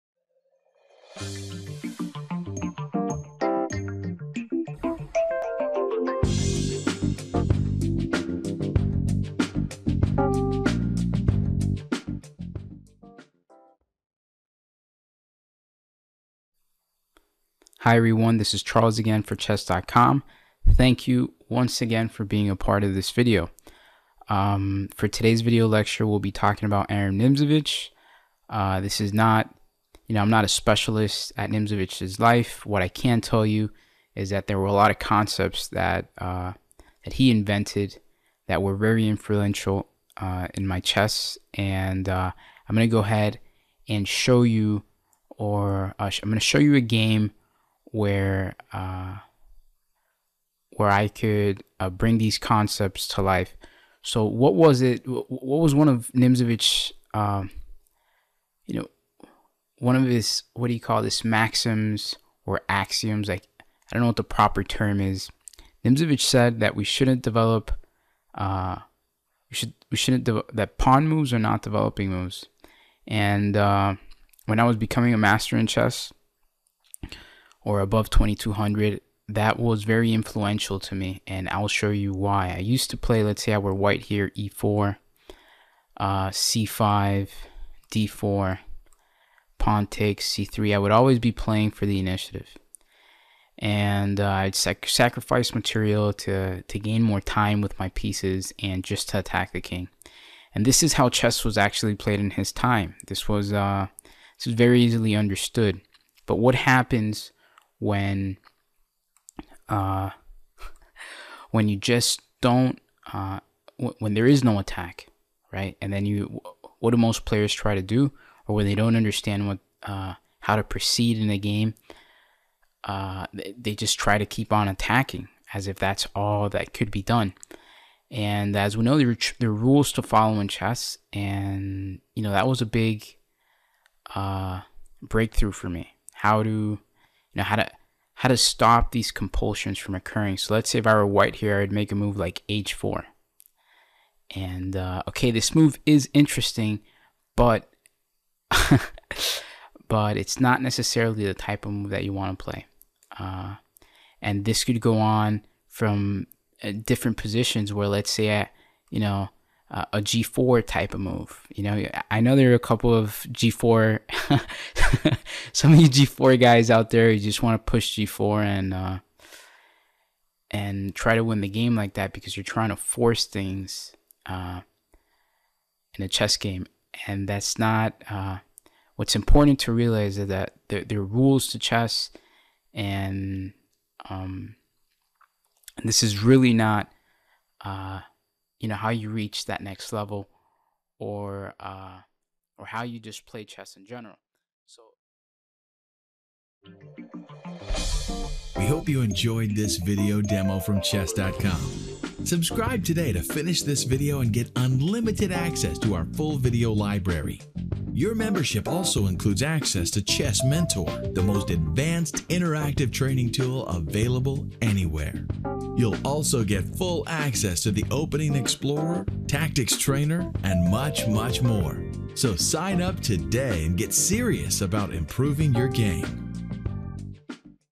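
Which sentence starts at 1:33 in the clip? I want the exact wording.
And uh, I'd sac sacrifice material to, to gain more time with my pieces and just to attack the king.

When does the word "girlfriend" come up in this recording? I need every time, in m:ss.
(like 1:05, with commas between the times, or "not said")
not said.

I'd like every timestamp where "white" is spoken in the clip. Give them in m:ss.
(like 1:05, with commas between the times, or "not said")
1:23, 2:21.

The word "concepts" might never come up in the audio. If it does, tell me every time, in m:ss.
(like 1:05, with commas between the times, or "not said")
0:34, 0:52.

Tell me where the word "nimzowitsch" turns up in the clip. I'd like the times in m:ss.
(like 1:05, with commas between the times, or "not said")
0:27, 0:31, 0:56, 1:05.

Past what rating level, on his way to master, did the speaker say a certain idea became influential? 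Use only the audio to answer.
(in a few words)
2200.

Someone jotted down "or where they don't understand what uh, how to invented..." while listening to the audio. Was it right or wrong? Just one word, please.
wrong.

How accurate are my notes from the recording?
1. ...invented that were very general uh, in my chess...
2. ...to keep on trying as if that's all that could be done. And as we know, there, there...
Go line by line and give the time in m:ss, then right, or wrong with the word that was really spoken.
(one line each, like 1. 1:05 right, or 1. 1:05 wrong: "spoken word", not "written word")
1. 0:37 wrong: "influential", not "general"
2. 2:04 wrong: "attacking", not "trying".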